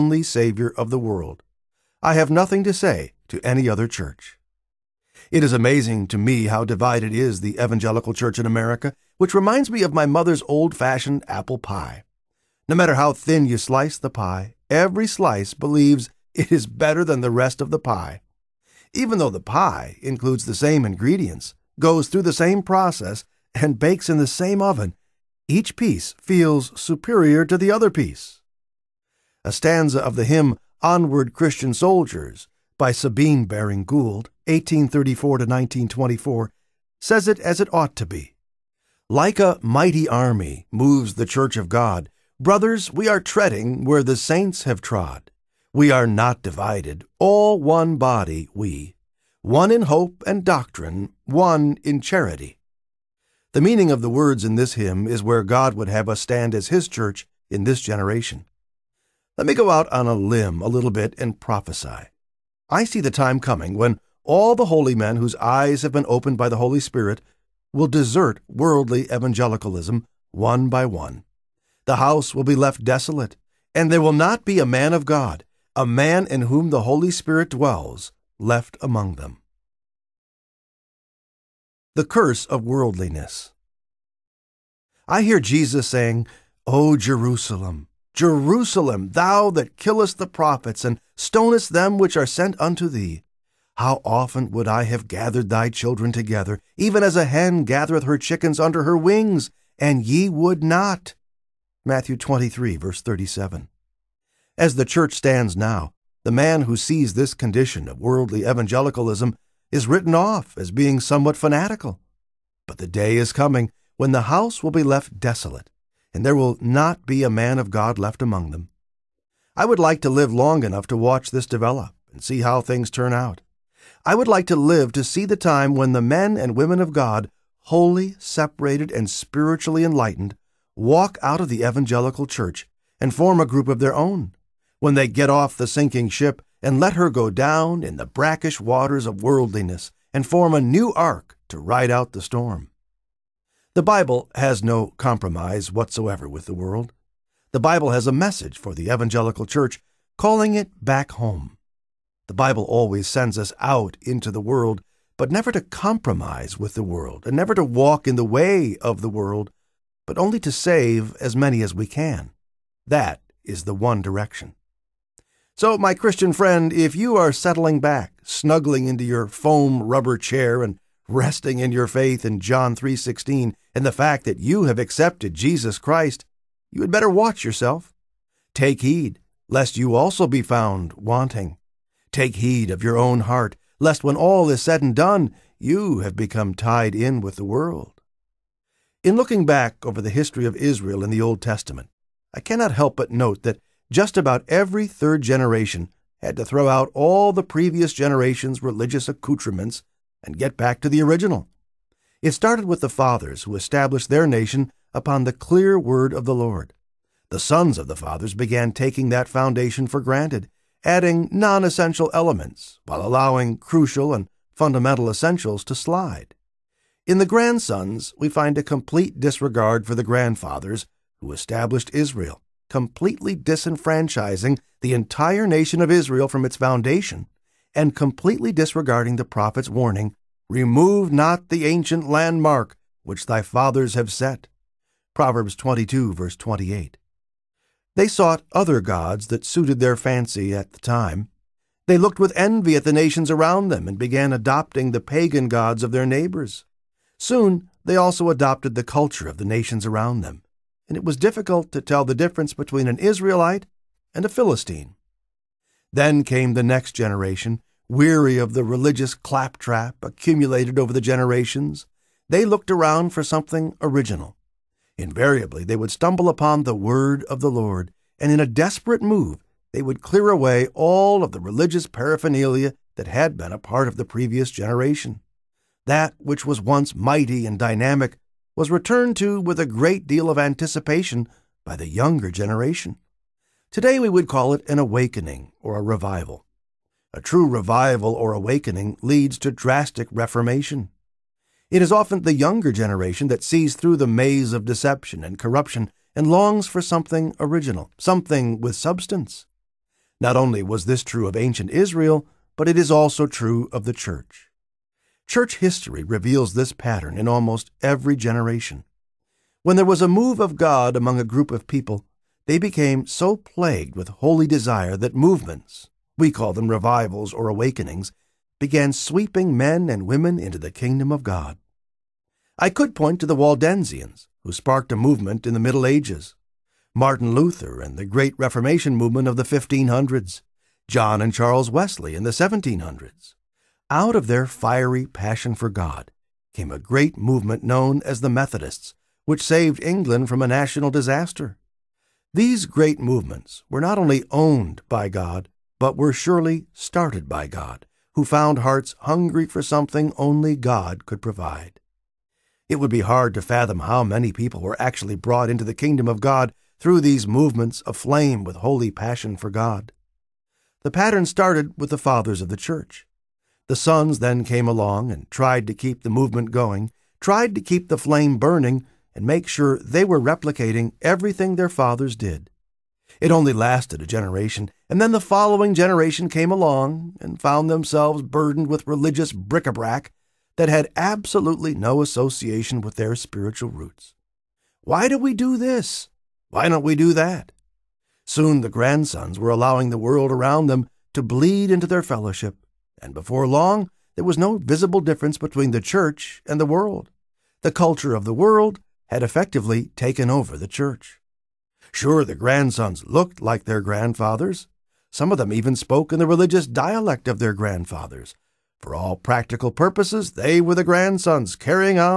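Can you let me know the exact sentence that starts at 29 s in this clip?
A stanza of the hymn Onward Christian Soldiers by Sabine Baring Gould, 1834 to 1924, says it as it ought to be.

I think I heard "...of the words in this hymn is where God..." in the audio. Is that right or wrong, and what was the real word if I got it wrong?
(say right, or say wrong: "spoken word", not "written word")
right.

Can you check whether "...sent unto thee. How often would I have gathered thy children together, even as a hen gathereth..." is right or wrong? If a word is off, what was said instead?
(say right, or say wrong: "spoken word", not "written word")
right.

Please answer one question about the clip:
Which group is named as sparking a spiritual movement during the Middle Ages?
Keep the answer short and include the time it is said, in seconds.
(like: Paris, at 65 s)
Waldensians, at 323 s.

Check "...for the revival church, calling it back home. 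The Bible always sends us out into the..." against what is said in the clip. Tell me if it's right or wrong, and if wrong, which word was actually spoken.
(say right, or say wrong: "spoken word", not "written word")
wrong: "evangelical", not "revival".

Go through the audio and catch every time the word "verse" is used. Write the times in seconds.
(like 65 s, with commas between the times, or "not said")
102 s, 236 s.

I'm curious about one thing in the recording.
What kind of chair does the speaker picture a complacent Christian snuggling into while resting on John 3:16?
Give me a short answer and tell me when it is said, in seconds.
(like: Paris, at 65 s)
foam rubber chair, at 169 s.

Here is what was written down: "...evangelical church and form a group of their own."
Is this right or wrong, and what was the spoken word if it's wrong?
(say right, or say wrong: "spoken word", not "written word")
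right.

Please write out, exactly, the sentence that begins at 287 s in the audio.
A true revival or awakening leads to drastic reformation.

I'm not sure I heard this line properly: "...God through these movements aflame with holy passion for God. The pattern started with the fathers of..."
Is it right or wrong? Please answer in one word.
right.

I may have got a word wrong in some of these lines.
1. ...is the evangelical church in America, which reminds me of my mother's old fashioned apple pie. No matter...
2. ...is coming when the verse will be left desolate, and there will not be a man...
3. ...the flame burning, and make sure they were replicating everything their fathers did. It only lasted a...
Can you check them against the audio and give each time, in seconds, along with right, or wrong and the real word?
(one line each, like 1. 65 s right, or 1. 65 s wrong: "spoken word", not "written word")
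1. 7 s right
2. 113 s wrong: "house", not "verse"
3. 367 s right.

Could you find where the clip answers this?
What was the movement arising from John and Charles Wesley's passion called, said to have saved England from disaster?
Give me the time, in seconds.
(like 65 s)
338 s.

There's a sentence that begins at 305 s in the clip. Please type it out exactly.
Church history reveals this pattern in almost every generation.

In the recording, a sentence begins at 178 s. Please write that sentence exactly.
Take heed lest you also be found wanting.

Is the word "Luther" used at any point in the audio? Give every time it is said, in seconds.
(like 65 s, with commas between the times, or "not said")
327 s.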